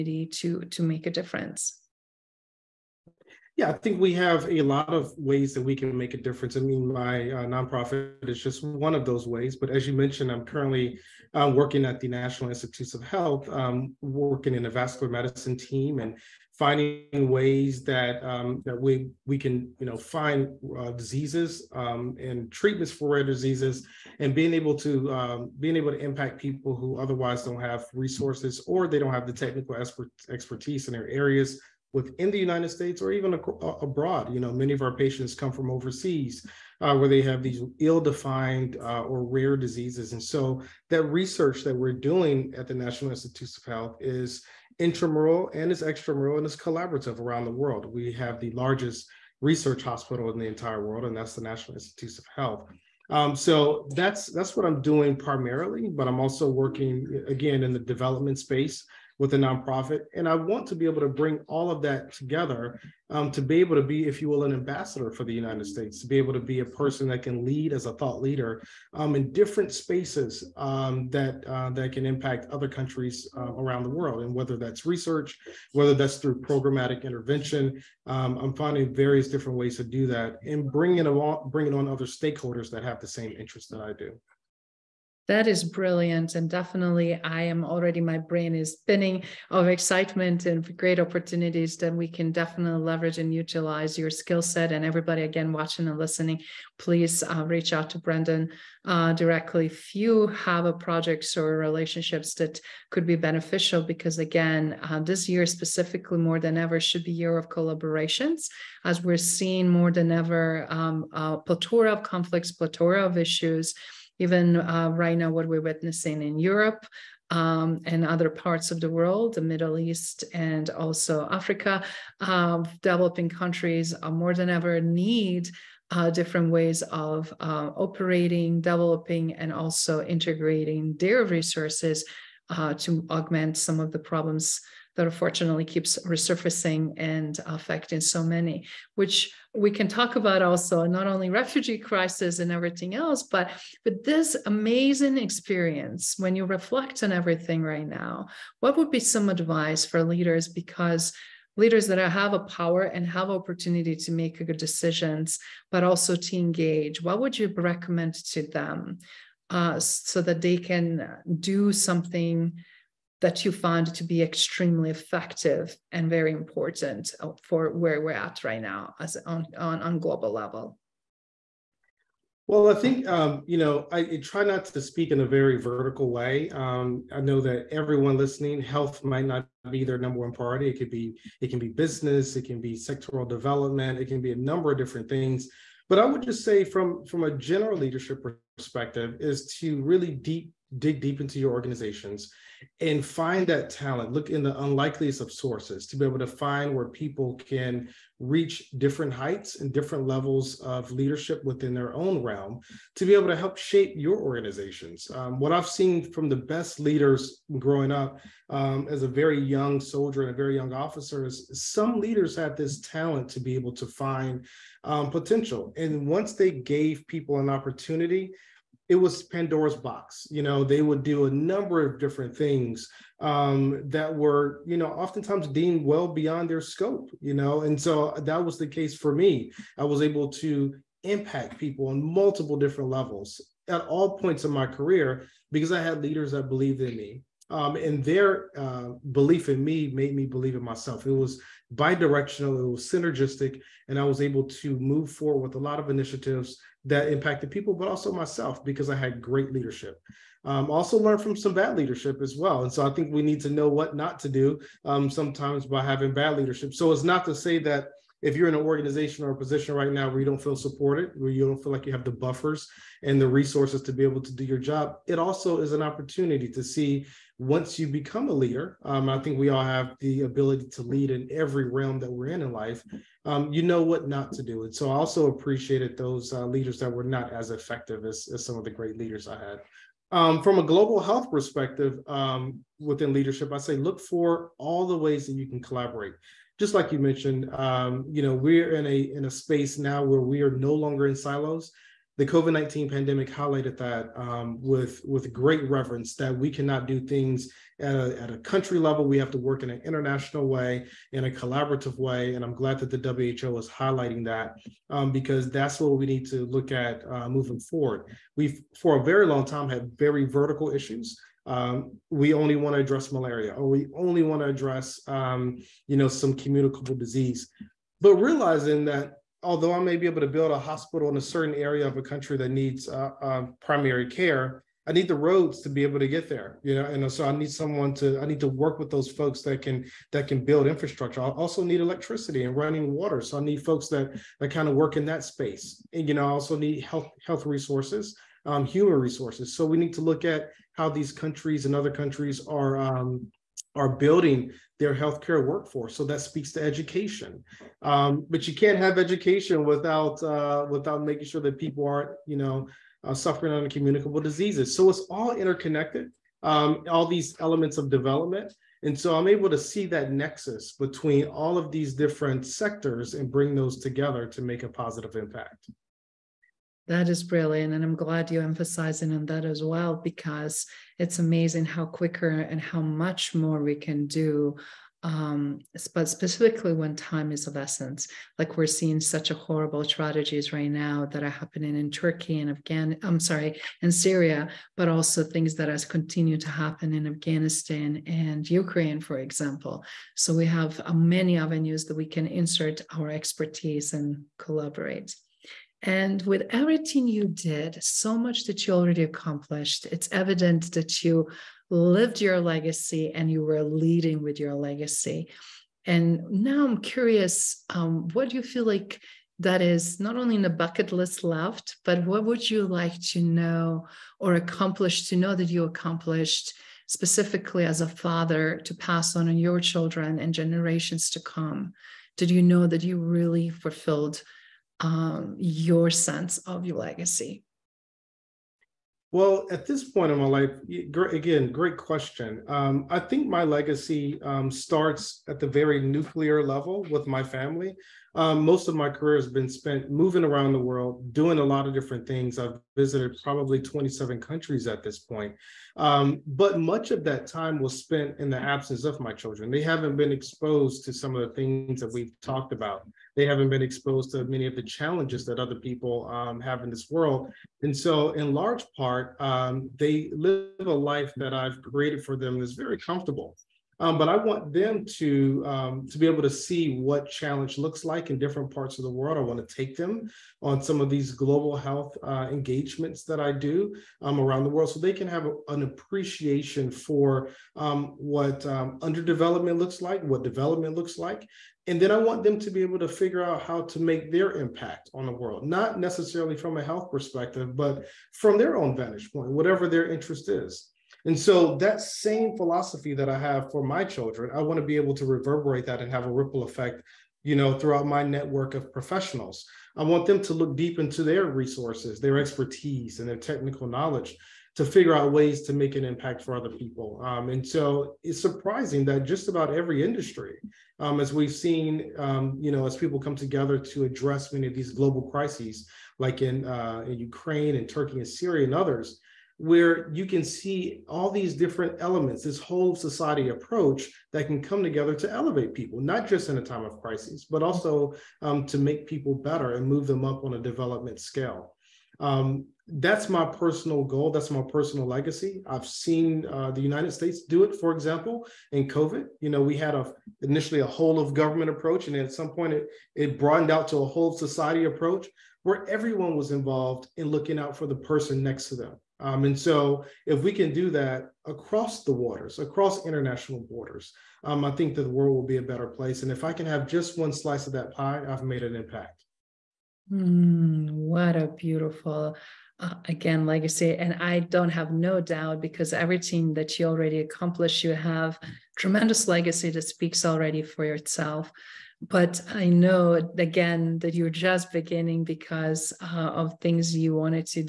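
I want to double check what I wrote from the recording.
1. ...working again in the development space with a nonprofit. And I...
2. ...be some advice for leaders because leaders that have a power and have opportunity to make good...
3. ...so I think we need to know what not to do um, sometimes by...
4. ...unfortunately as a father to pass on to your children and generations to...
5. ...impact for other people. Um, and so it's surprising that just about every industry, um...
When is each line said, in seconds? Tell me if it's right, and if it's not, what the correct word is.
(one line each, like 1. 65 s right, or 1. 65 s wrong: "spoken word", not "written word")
1. 56 s right
2. 148 s right
3. 252 s right
4. 416 s wrong: "specifically", not "unfortunately"
5. 505 s right.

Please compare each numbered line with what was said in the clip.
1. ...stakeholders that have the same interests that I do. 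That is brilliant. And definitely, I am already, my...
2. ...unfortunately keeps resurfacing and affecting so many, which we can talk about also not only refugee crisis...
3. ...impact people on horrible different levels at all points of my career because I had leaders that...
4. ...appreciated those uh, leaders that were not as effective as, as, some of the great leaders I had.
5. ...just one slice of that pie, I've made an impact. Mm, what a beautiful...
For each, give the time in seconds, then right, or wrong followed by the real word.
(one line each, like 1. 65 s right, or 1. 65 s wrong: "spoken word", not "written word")
1. 82 s right
2. 135 s right
3. 231 s wrong: "multiple", not "horrible"
4. 275 s right
5. 556 s right.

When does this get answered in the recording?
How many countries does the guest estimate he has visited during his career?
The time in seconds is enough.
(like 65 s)
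443 s.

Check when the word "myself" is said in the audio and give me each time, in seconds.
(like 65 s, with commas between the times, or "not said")
240 s, 248 s.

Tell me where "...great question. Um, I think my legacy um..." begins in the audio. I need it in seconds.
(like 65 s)
431 s.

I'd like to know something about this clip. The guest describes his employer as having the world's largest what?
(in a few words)
research hospital.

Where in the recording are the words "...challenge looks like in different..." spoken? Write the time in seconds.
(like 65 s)
467 s.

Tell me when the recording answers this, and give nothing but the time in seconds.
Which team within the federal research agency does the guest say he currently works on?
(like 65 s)
14 s.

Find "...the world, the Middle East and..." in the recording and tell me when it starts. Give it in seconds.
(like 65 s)
118 s.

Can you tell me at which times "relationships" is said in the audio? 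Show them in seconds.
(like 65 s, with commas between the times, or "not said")
101 s.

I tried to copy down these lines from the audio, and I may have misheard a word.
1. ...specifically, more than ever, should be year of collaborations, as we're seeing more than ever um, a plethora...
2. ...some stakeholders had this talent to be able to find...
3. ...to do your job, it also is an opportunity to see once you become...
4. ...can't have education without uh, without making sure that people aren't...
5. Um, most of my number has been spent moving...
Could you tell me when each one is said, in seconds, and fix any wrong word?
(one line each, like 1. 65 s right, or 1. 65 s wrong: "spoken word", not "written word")
1. 105 s right
2. 211 s wrong: "leaders", not "stakeholders"
3. 264 s right
4. 348 s right
5. 438 s wrong: "career", not "number".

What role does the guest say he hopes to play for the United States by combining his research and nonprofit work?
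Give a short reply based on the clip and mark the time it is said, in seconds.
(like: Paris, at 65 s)
ambassador, at 64 s.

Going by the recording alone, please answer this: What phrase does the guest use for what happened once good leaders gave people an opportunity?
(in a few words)
Pandora's box.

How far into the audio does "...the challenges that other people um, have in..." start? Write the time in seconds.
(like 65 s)
454 s.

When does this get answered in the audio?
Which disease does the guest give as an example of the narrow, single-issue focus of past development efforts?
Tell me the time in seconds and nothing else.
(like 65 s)
313 s.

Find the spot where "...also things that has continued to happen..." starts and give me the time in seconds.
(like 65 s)
384 s.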